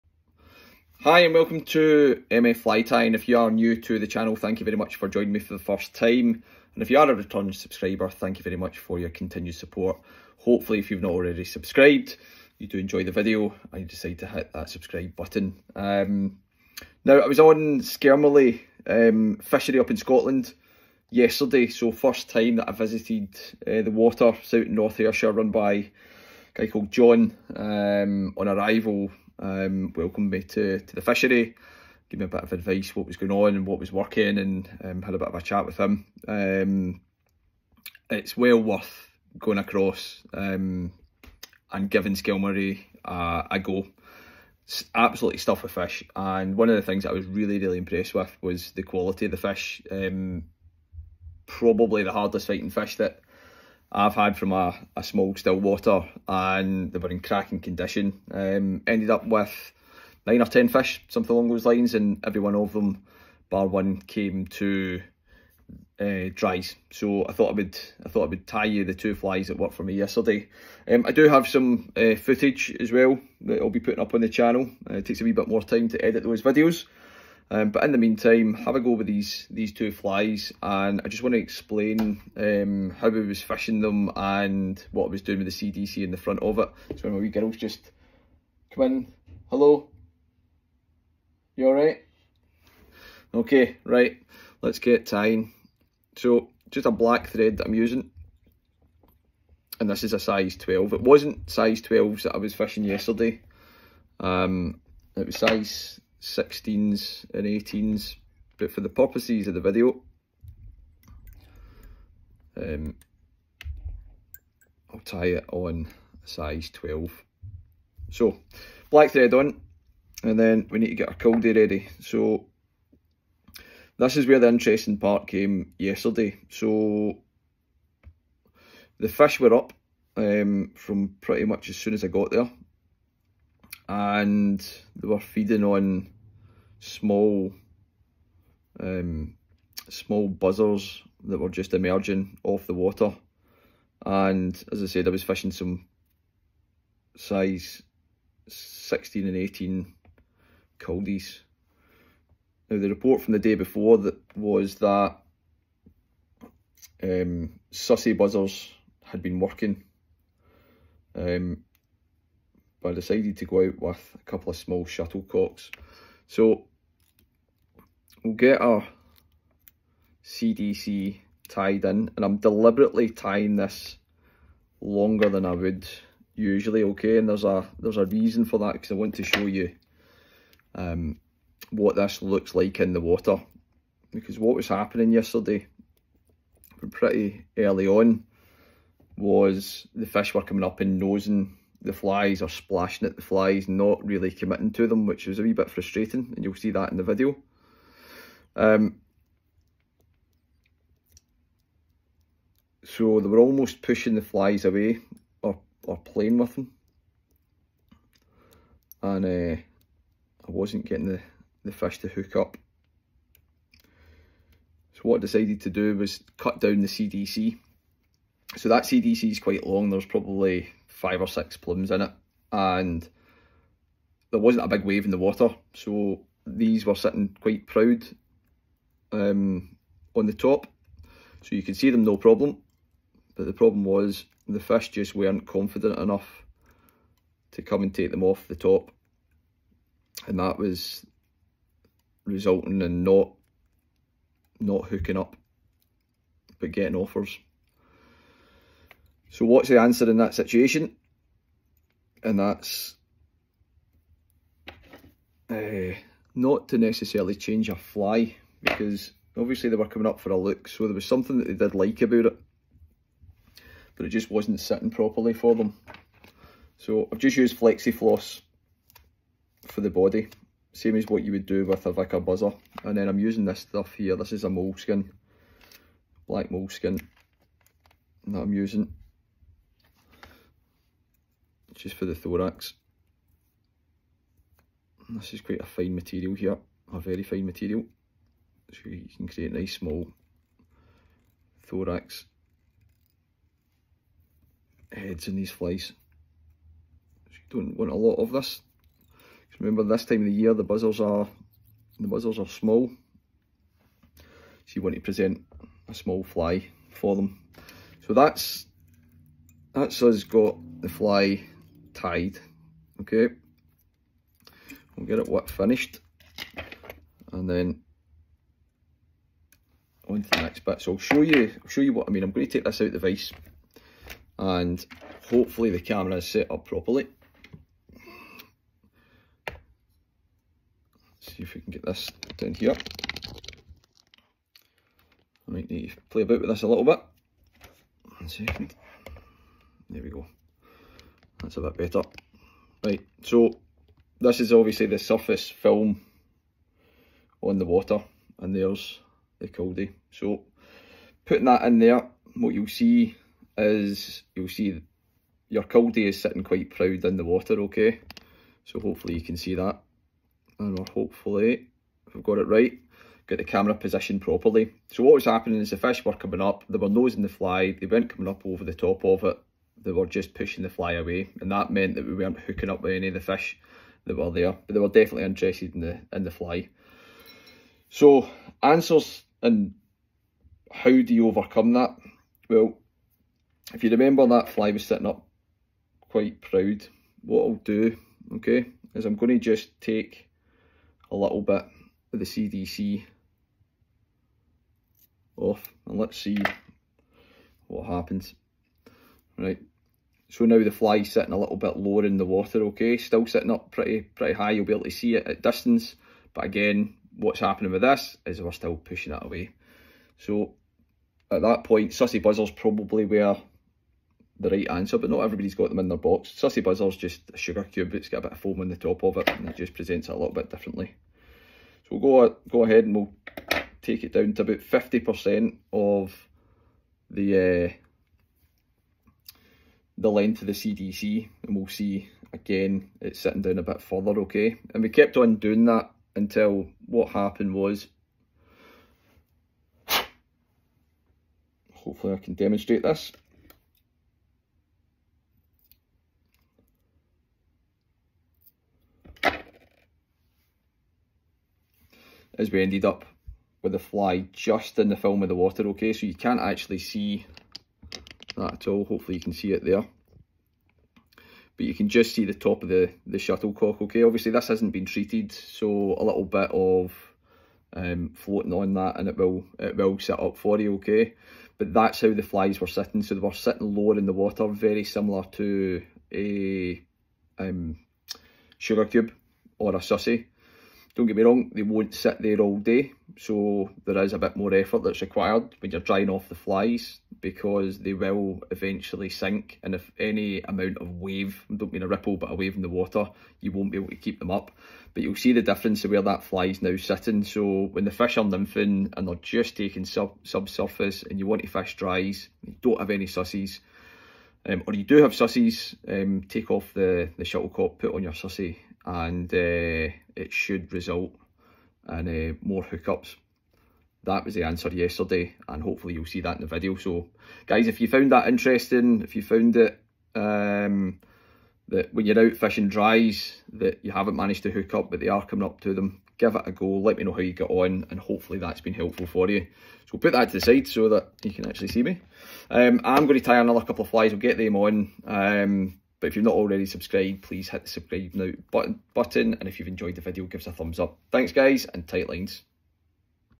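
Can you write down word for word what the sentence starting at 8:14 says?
But you'll see the difference of where that fly is now sitting.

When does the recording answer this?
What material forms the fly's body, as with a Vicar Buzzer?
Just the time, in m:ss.
4:27.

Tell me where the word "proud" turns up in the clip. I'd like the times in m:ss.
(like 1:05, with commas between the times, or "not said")
3:47, 5:56, 6:26.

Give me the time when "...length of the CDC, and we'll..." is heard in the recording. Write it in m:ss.
7:10.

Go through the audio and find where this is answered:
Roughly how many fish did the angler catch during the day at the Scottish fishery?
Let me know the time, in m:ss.
1:00.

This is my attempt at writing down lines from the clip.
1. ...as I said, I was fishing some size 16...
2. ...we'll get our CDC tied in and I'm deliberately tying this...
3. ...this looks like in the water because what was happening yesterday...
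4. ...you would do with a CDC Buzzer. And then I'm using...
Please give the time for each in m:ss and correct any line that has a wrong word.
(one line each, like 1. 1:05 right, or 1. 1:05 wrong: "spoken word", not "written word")
1. 2:24 right
2. 2:48 right
3. 3:01 right
4. 4:31 wrong: "Vicar", not "CDC".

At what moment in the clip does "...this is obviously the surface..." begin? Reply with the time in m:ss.
5:44.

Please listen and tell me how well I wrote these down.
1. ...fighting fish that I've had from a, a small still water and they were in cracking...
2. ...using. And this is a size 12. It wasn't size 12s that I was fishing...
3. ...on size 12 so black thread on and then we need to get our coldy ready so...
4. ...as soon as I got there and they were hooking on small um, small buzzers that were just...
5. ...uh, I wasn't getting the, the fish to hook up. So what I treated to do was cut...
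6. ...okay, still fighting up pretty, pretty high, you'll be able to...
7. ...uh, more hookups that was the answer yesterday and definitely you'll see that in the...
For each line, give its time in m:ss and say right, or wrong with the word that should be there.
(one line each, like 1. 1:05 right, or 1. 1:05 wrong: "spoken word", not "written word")
1. 0:52 right
2. 1:37 right
3. 1:55 right
4. 2:11 wrong: "feeding", not "hooking"
5. 3:29 wrong: "decided", not "treated"
6. 6:42 wrong: "sitting", not "fighting"
7. 8:32 wrong: "hopefully", not "definitely".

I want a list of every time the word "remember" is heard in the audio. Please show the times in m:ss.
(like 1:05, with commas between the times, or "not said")
4:59, 6:23.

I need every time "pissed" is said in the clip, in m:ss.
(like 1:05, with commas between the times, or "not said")
not said.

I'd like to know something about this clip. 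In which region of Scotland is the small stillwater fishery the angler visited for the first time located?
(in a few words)
North Ayrshire.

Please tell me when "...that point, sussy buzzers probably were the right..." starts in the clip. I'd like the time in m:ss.
6:51.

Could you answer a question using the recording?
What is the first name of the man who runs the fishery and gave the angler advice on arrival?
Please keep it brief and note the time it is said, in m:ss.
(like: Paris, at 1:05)
John, at 0:26.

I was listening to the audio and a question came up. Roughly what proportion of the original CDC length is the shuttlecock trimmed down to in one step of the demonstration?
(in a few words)
50%.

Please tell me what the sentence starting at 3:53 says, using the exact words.
But the problem was the fish just weren't confident enough to come and take them off the top.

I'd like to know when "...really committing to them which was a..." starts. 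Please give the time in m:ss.
3:14.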